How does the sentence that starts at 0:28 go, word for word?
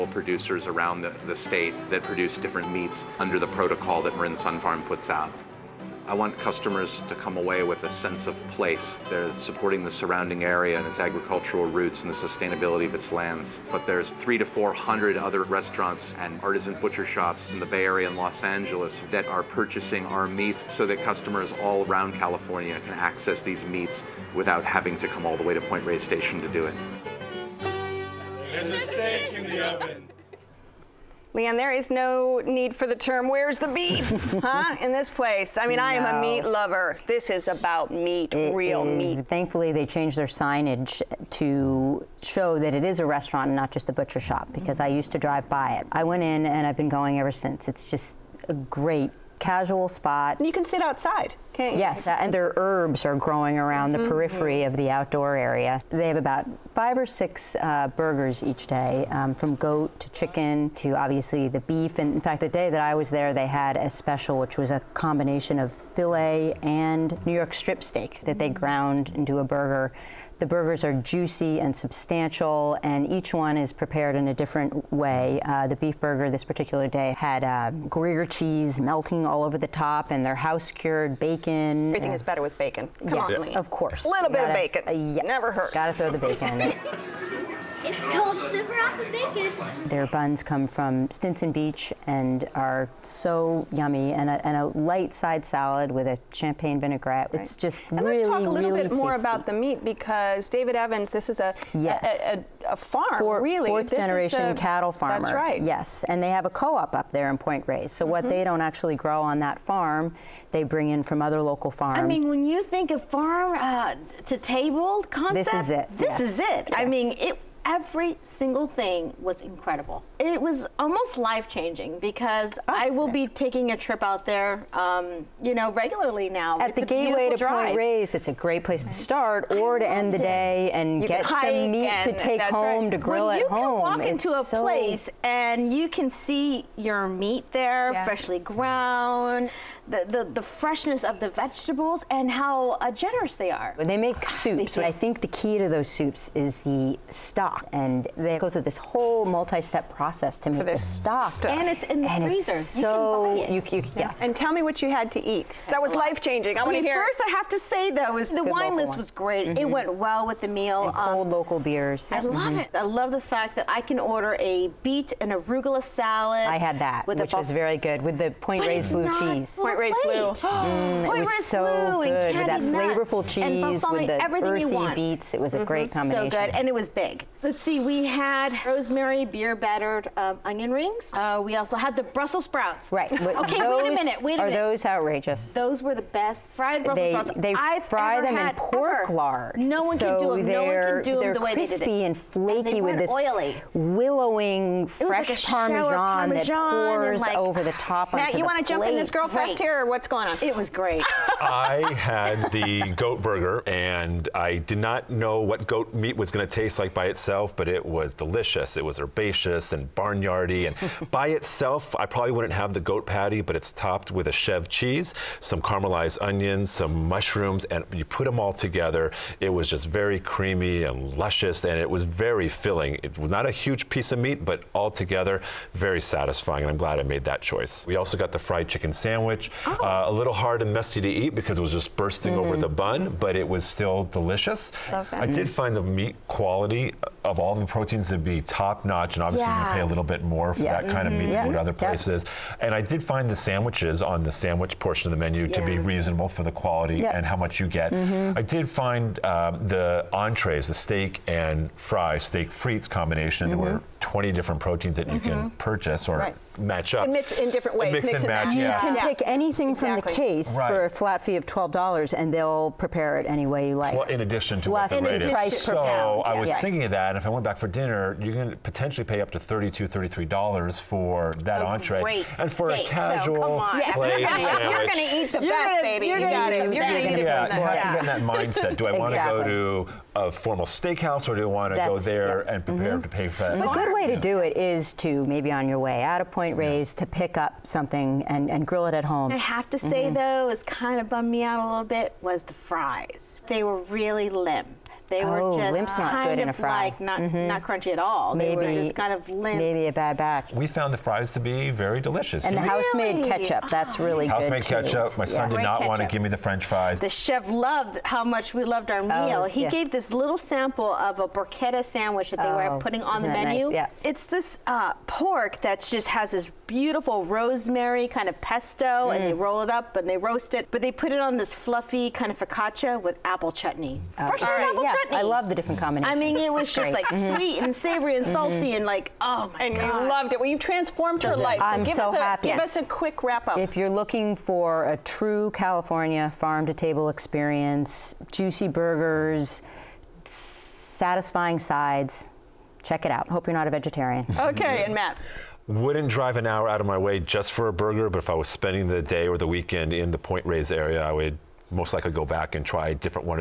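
There's a steak in the oven.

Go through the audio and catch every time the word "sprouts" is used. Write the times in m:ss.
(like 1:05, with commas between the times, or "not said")
3:02, 3:07.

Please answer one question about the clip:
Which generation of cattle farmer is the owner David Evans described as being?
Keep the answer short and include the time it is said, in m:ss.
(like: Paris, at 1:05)
Fourth, at 1:43.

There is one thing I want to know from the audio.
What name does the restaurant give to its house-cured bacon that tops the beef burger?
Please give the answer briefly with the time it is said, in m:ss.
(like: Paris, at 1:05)
Super awesome bacon, at 1:28.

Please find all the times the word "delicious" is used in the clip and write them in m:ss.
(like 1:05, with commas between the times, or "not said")
3:28, 3:54, 5:02.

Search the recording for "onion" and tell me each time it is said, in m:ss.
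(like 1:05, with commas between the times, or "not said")
3:00, 3:36.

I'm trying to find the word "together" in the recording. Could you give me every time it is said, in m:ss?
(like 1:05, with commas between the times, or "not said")
3:38, 3:44.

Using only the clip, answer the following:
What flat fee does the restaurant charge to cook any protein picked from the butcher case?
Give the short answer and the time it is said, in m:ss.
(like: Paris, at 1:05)
$12, at 4:21.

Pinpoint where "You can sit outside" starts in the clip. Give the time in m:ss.
0:50.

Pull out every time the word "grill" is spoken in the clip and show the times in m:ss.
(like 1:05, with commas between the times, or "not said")
2:12, 4:48.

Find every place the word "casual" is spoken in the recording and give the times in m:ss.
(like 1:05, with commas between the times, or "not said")
0:49, 4:32.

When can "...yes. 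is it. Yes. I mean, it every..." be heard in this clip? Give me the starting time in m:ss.
1:56.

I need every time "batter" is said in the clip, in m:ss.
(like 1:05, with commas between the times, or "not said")
2:59.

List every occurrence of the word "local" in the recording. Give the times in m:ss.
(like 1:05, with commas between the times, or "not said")
1:51, 2:41.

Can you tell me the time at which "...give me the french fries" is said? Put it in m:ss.
5:06.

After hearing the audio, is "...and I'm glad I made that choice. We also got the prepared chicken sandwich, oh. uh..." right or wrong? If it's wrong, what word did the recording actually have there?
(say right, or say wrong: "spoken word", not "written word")
wrong: "fried", not "prepared".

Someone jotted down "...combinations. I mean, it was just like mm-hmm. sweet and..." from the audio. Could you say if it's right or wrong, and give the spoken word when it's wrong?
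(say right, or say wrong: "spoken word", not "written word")
right.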